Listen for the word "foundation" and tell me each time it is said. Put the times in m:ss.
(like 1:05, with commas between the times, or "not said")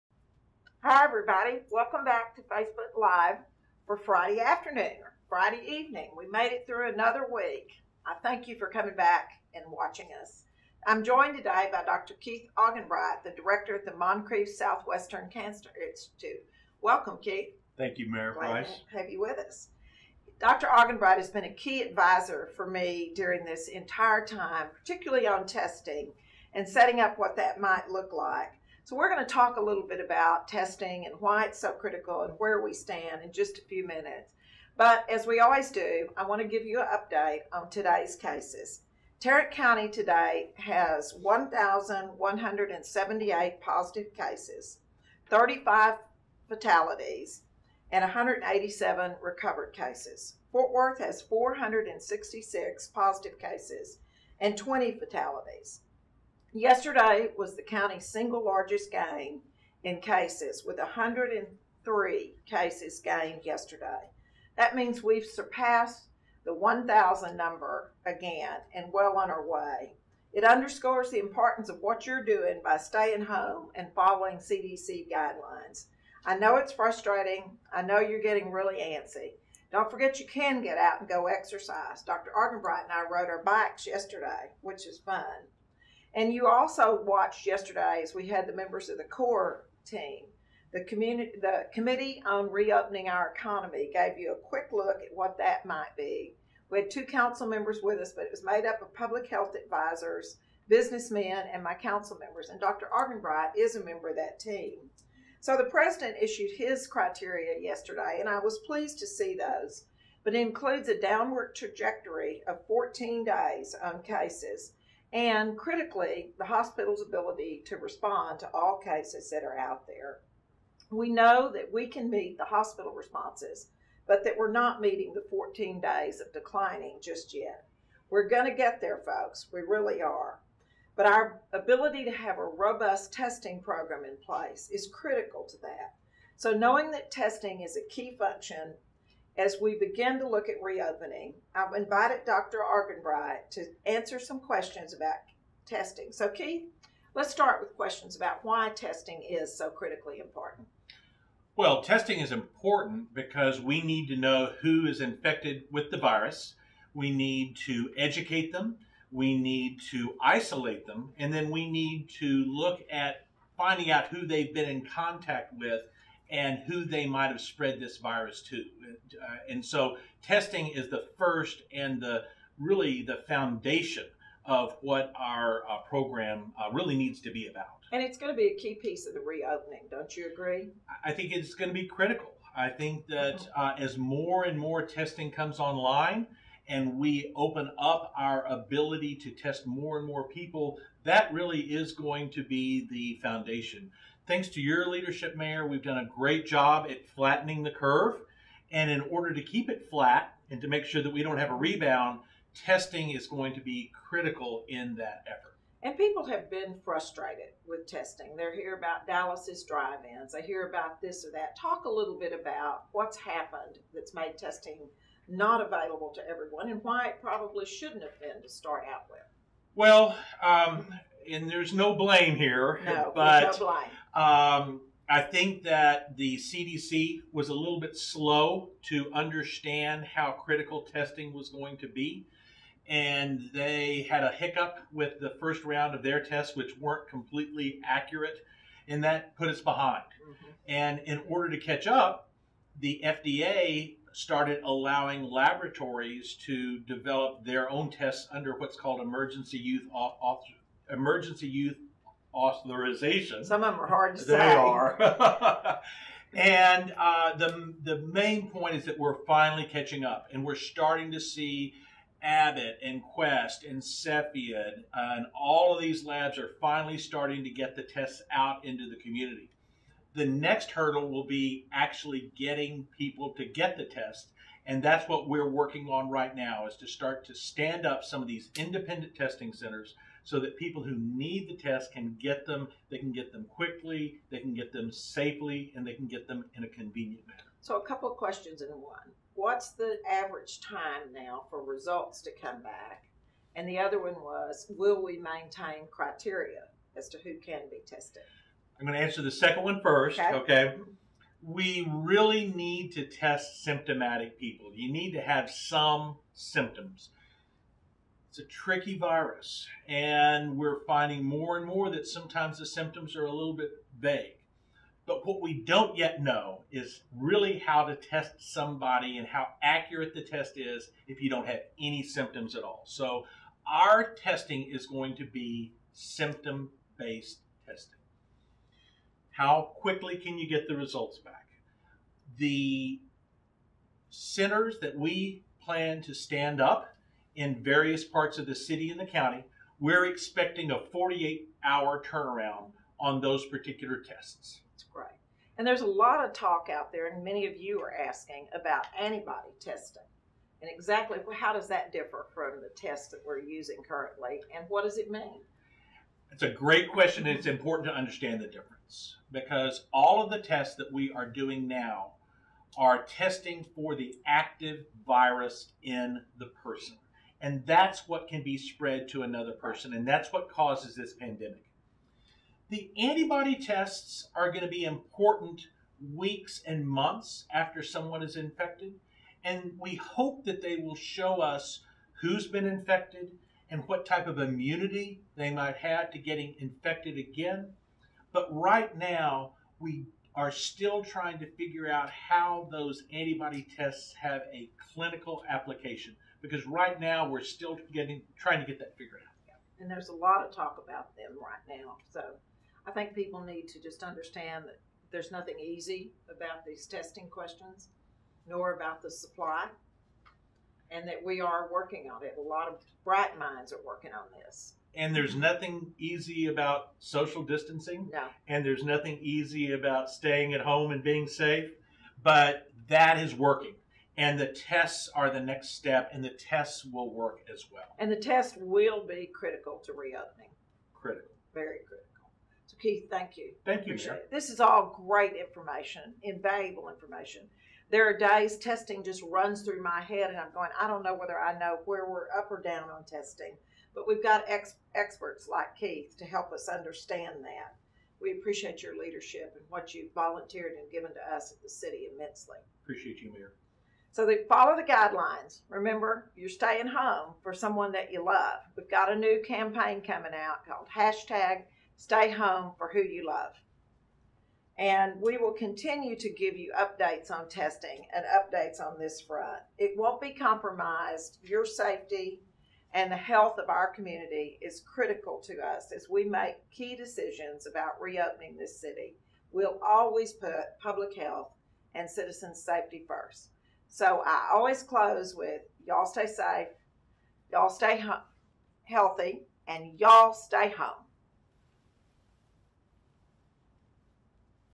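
2:53, 3:13.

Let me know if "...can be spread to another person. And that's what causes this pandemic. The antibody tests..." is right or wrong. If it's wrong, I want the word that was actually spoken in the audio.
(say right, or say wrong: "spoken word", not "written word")
right.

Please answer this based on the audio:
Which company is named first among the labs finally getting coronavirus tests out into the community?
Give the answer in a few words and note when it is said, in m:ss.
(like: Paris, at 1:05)
Abbott, at 4:22.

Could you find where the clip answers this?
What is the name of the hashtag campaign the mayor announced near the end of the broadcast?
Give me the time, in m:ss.
7:41.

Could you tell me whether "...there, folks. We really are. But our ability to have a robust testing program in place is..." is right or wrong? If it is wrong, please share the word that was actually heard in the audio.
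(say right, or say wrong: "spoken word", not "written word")
right.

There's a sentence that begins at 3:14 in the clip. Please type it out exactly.
Thanks to your leadership, Mayor, we've done a great job at flattening the curve.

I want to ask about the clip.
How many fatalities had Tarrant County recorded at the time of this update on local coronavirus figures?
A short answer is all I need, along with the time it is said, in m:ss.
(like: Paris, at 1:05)
35, at 0:45.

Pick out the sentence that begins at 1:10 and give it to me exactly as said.
It underscores the importance of what you're doing by staying home and following CDC guidelines.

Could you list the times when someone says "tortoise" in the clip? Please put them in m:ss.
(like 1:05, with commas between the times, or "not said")
not said.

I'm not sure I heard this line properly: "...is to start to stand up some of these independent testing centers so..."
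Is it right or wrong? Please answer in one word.
right.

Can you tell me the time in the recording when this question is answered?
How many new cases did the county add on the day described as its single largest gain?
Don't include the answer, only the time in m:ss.
1:00.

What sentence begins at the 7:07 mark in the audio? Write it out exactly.
And the test will be critical to reopening.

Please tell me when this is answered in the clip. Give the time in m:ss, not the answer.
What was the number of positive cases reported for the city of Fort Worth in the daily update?
0:51.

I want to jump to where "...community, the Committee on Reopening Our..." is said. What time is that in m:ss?
1:30.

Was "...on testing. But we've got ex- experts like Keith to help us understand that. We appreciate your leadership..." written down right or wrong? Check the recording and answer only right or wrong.
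right.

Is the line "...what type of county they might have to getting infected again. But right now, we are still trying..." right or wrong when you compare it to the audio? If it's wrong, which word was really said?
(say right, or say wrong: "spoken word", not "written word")
wrong: "immunity", not "county".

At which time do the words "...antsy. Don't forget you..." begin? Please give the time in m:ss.
1:18.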